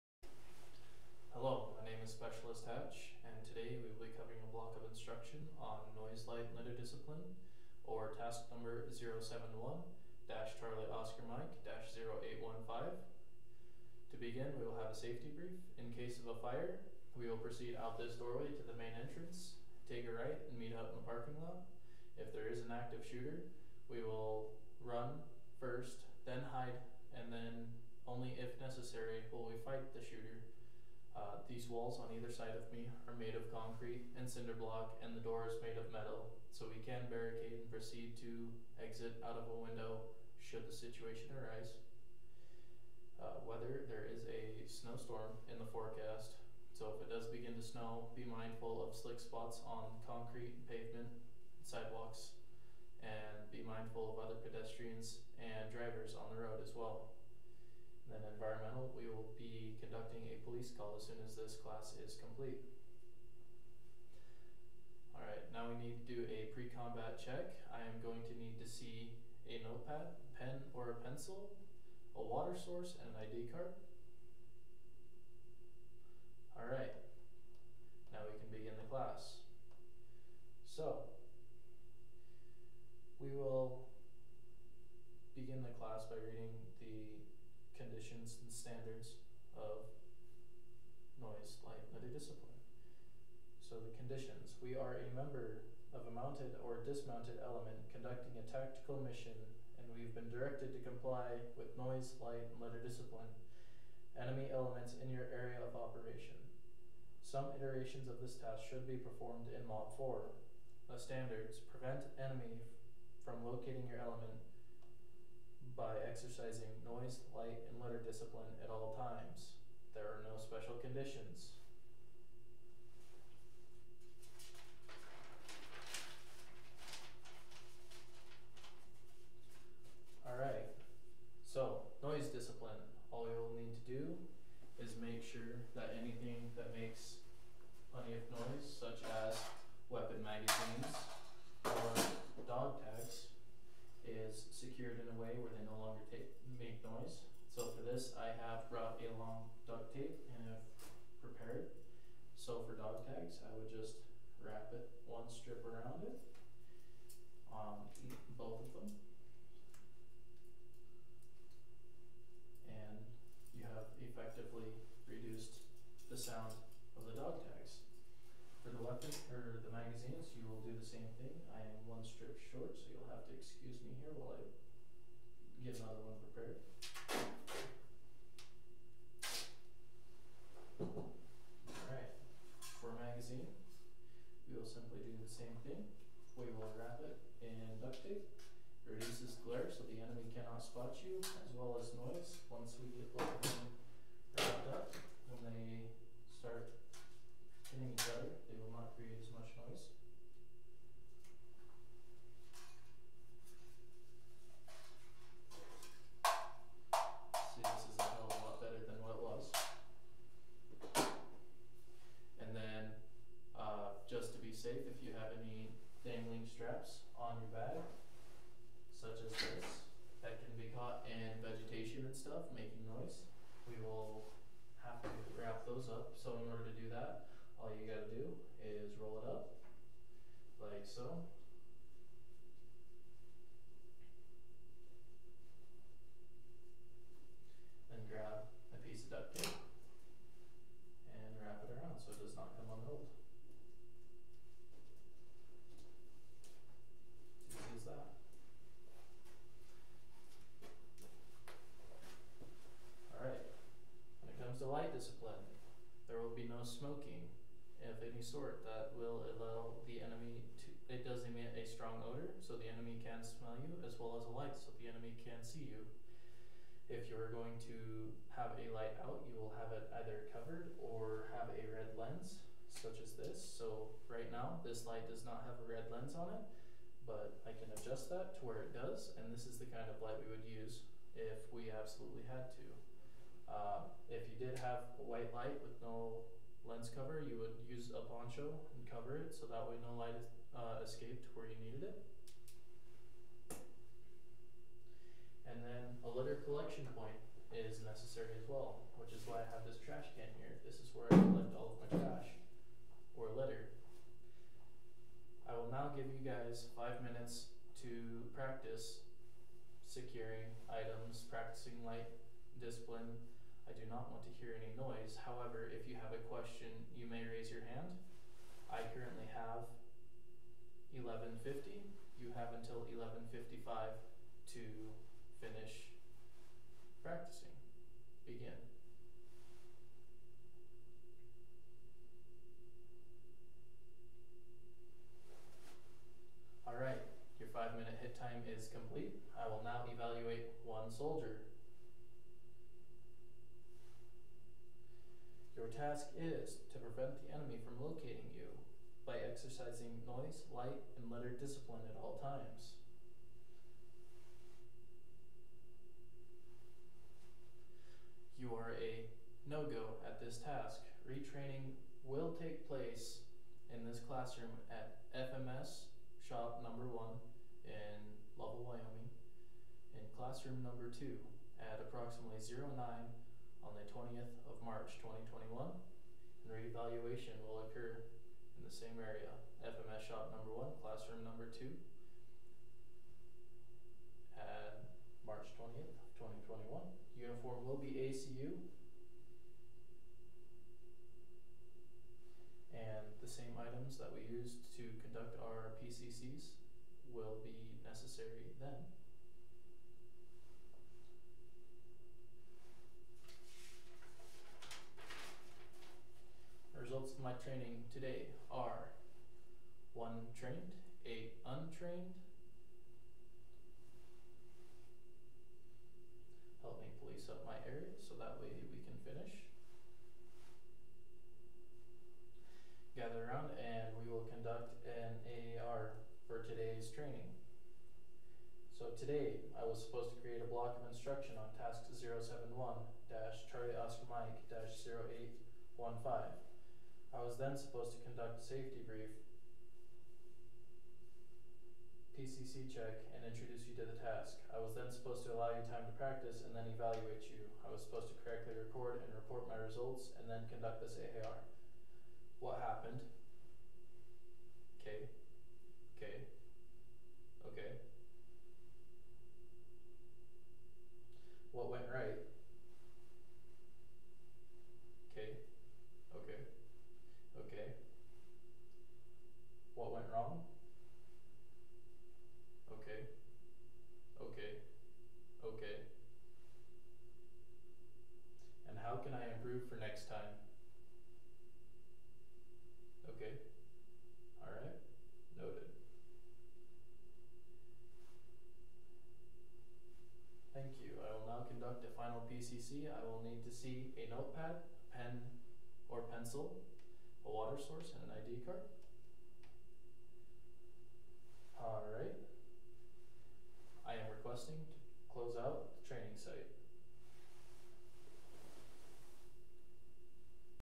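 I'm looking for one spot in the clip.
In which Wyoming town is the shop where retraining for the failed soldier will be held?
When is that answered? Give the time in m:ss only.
6:08.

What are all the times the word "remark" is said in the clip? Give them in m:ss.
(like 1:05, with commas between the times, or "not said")
not said.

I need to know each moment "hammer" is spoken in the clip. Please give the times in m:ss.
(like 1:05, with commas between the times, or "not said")
not said.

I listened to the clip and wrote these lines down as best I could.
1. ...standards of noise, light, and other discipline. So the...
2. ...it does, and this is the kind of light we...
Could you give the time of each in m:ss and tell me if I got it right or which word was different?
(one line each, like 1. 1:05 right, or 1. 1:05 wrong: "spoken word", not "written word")
1. 1:28 right
2. 4:38 right.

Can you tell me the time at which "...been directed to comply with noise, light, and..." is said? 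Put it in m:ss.
1:40.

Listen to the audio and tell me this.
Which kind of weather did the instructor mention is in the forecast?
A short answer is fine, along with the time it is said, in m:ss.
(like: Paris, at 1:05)
snowstorm, at 0:44.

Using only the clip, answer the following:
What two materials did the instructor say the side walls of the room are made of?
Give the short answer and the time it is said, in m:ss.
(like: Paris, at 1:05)
concrete and cinder block, at 0:33.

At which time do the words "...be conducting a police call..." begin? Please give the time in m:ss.
0:59.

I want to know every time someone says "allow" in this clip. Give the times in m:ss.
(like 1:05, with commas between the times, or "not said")
4:19, 7:25.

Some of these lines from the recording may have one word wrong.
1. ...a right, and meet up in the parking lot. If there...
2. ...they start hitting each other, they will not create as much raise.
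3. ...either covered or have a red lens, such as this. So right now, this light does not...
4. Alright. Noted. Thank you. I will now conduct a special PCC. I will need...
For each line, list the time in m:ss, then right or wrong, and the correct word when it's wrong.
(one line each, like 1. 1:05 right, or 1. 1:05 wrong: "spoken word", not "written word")
1. 0:20 right
2. 3:15 wrong: "noise", not "raise"
3. 4:30 right
4. 8:04 wrong: "final", not "special".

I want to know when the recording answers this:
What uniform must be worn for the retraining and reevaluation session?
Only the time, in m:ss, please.
6:28.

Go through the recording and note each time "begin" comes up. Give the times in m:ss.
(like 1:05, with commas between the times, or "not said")
0:14, 0:47, 1:18, 1:25, 5:28.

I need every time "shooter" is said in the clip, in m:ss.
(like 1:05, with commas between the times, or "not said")
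0:23, 0:30.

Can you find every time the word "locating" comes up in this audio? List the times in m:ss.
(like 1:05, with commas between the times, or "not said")
1:53, 5:47.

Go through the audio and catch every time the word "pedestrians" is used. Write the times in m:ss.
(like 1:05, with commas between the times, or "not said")
0:54.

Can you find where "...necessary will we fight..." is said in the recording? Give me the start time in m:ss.
0:28.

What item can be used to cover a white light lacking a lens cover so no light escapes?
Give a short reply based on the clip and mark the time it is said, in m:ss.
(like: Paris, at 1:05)
poncho, at 4:48.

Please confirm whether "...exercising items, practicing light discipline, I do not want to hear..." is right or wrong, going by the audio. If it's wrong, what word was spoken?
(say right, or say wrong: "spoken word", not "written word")
wrong: "securing", not "exercising".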